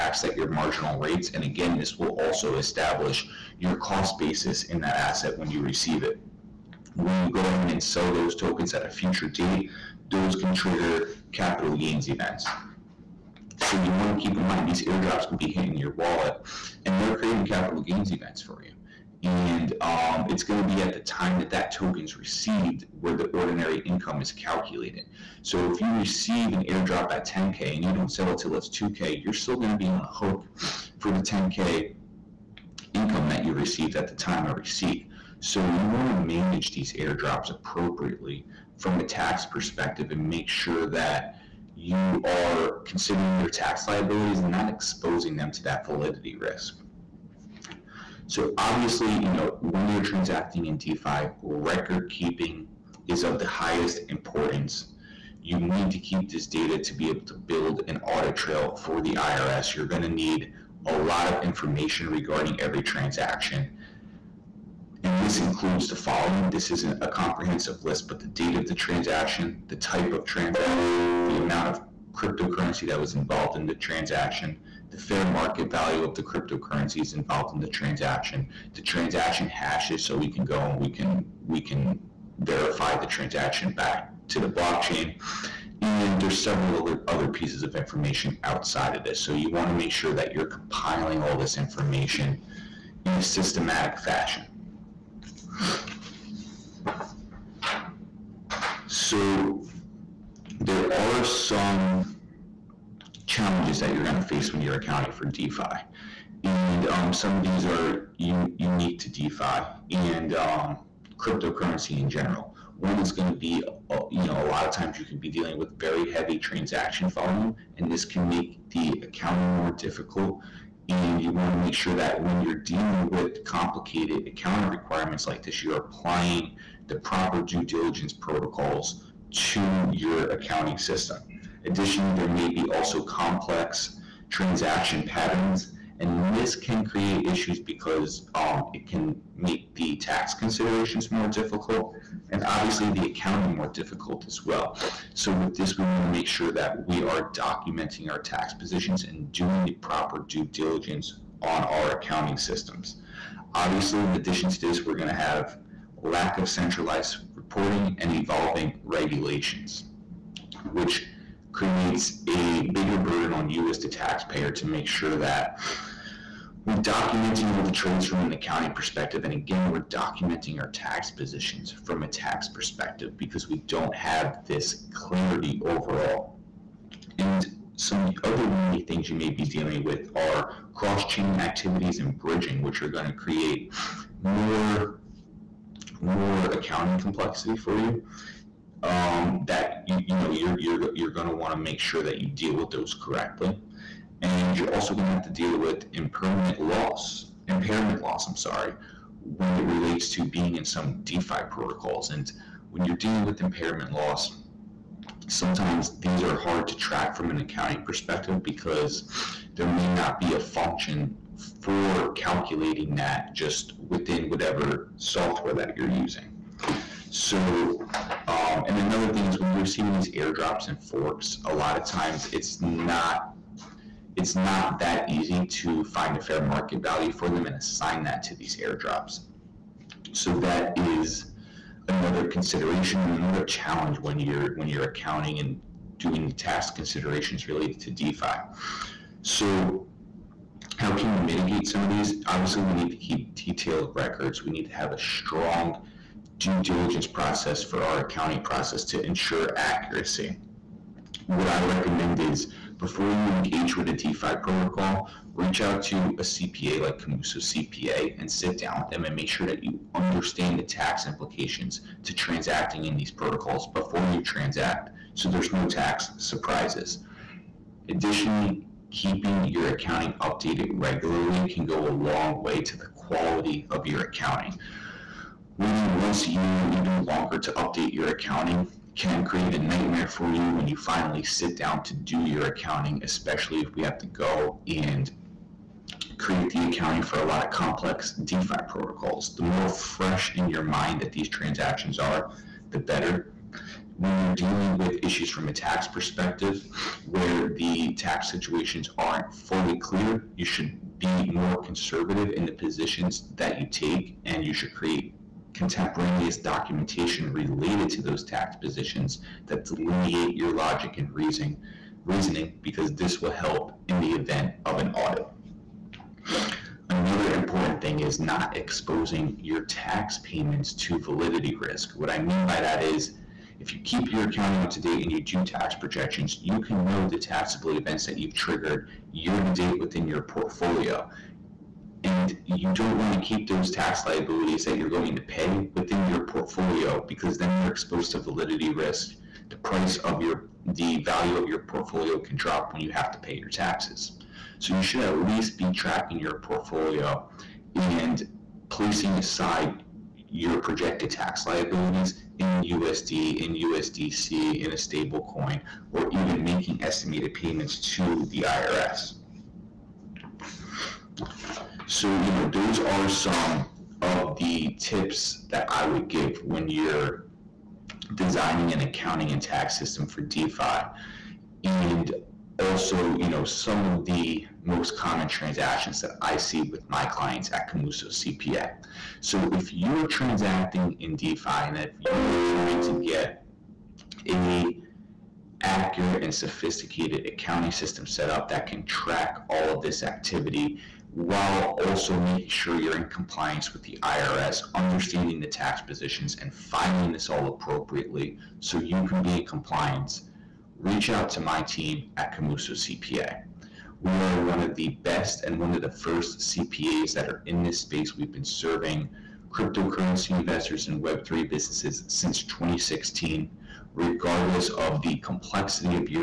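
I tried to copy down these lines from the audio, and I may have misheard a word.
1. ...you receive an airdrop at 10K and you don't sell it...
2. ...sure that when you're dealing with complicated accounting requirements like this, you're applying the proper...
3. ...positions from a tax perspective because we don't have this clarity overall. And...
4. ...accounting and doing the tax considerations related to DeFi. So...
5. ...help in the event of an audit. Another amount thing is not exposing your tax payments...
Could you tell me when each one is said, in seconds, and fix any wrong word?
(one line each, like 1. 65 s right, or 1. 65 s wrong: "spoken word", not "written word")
1. 25 s right
2. 121 s right
3. 171 s right
4. 234 s right
5. 313 s wrong: "important", not "amount".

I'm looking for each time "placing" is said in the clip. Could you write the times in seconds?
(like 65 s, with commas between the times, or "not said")
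348 s.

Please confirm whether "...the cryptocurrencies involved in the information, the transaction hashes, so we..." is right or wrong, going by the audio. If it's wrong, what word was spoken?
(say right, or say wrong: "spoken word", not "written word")
wrong: "transaction", not "information".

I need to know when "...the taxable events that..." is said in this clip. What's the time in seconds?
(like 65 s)
327 s.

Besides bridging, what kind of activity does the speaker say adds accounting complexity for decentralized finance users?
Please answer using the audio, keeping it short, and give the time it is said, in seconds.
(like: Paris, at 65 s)
cross chain activities, at 180 s.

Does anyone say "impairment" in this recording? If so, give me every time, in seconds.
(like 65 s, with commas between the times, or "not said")
197 s, 203 s.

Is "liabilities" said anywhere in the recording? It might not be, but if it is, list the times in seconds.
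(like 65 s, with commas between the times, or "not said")
43 s, 334 s, 351 s.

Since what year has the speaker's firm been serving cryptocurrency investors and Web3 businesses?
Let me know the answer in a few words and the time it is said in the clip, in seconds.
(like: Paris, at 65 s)
2016, at 412 s.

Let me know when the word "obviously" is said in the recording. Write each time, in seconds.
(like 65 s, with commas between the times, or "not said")
48 s, 142 s, 153 s, 242 s.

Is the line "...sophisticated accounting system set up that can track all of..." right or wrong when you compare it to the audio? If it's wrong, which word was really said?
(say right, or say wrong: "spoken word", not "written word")
right.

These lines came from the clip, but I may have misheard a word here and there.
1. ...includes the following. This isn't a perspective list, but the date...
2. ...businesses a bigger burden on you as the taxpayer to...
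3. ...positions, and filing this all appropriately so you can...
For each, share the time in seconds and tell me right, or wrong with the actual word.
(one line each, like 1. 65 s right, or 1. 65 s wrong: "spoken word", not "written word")
1. 65 s wrong: "comprehensive", not "perspective"
2. 161 s wrong: "creates", not "businesses"
3. 395 s right.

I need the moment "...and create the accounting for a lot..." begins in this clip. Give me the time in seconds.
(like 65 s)
284 s.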